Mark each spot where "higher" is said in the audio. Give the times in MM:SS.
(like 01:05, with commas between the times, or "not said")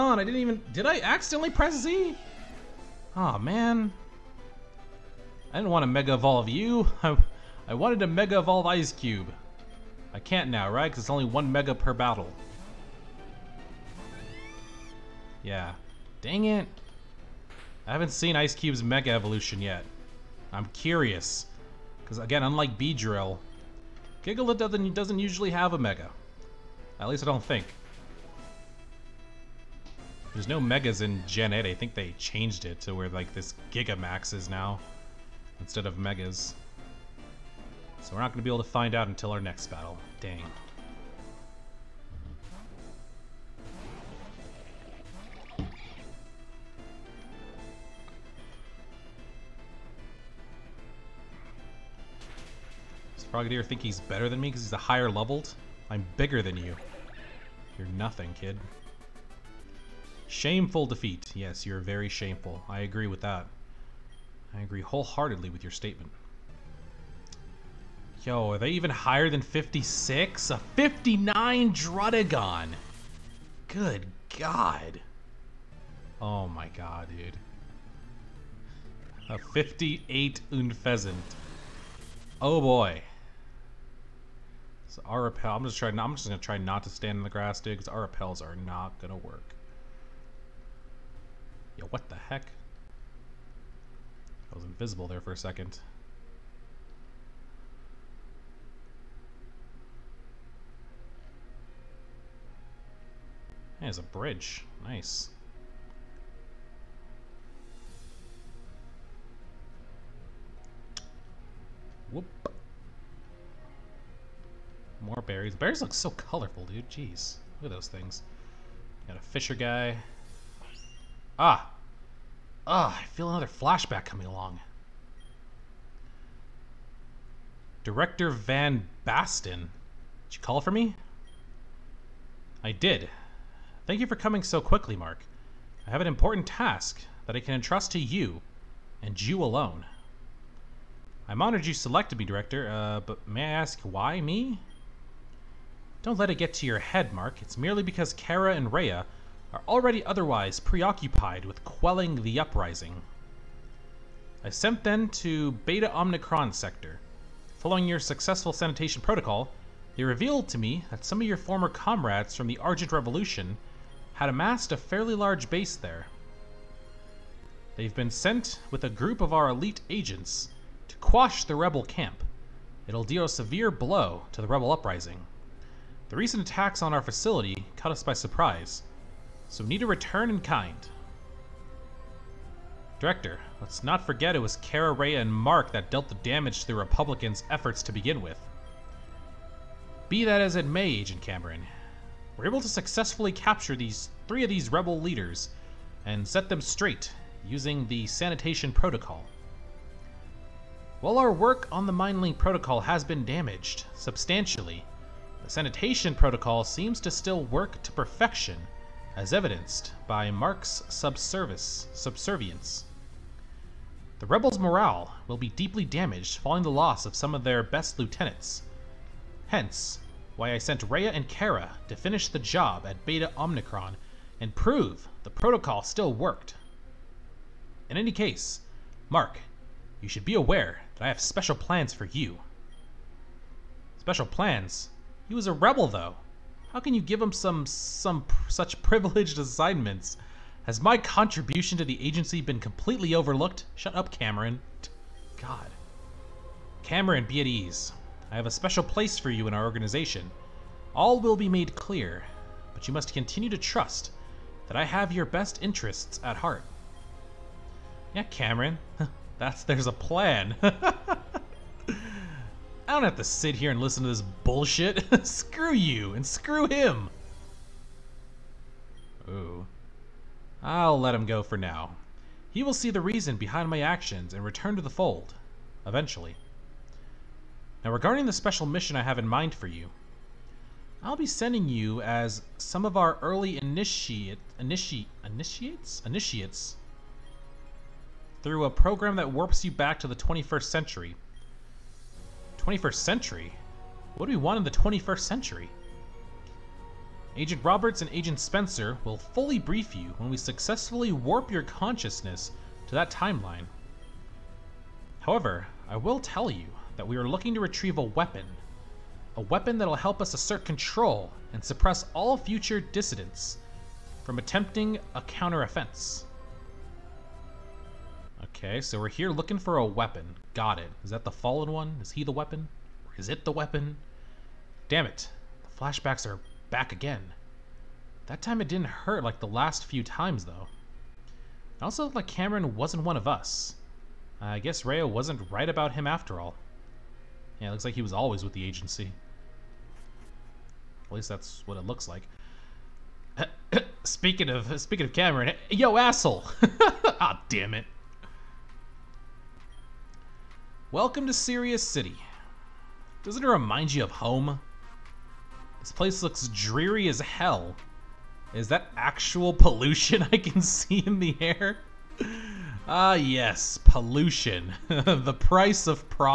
00:54, 01:08.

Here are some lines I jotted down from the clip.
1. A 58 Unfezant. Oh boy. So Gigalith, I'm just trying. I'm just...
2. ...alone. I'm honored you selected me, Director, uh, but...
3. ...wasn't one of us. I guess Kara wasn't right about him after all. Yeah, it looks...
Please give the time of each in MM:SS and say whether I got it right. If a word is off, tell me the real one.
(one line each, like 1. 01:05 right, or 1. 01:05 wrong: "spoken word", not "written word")
1. 01:19 wrong: "Arapel", not "Gigalith"
2. 02:19 right
3. 05:32 wrong: "Rayo", not "Kara".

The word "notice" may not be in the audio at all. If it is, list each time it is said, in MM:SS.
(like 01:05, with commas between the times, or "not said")
not said.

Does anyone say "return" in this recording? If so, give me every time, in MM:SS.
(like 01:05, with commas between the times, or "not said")
02:59, 04:34.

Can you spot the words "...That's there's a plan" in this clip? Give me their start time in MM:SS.
04:19.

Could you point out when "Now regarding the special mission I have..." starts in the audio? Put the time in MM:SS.
04:37.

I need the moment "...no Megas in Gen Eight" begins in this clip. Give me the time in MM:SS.
00:30.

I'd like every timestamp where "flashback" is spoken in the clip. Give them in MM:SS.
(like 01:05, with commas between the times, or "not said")
02:03, 05:25.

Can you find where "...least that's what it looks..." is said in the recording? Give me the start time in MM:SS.
05:41.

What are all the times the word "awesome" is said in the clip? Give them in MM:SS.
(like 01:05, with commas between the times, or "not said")
not said.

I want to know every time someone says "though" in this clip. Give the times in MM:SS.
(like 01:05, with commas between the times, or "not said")
03:55, 05:30.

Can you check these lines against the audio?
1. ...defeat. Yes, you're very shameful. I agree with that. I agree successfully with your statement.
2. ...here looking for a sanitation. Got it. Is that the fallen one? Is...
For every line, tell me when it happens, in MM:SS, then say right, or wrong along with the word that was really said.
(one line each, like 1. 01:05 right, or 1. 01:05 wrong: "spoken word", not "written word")
1. 01:00 wrong: "wholeheartedly", not "successfully"
2. 05:19 wrong: "weapon", not "sanitation".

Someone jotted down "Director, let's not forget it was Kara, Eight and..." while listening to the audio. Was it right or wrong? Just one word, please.
wrong.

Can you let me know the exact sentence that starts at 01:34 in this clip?
was invisible there for a second.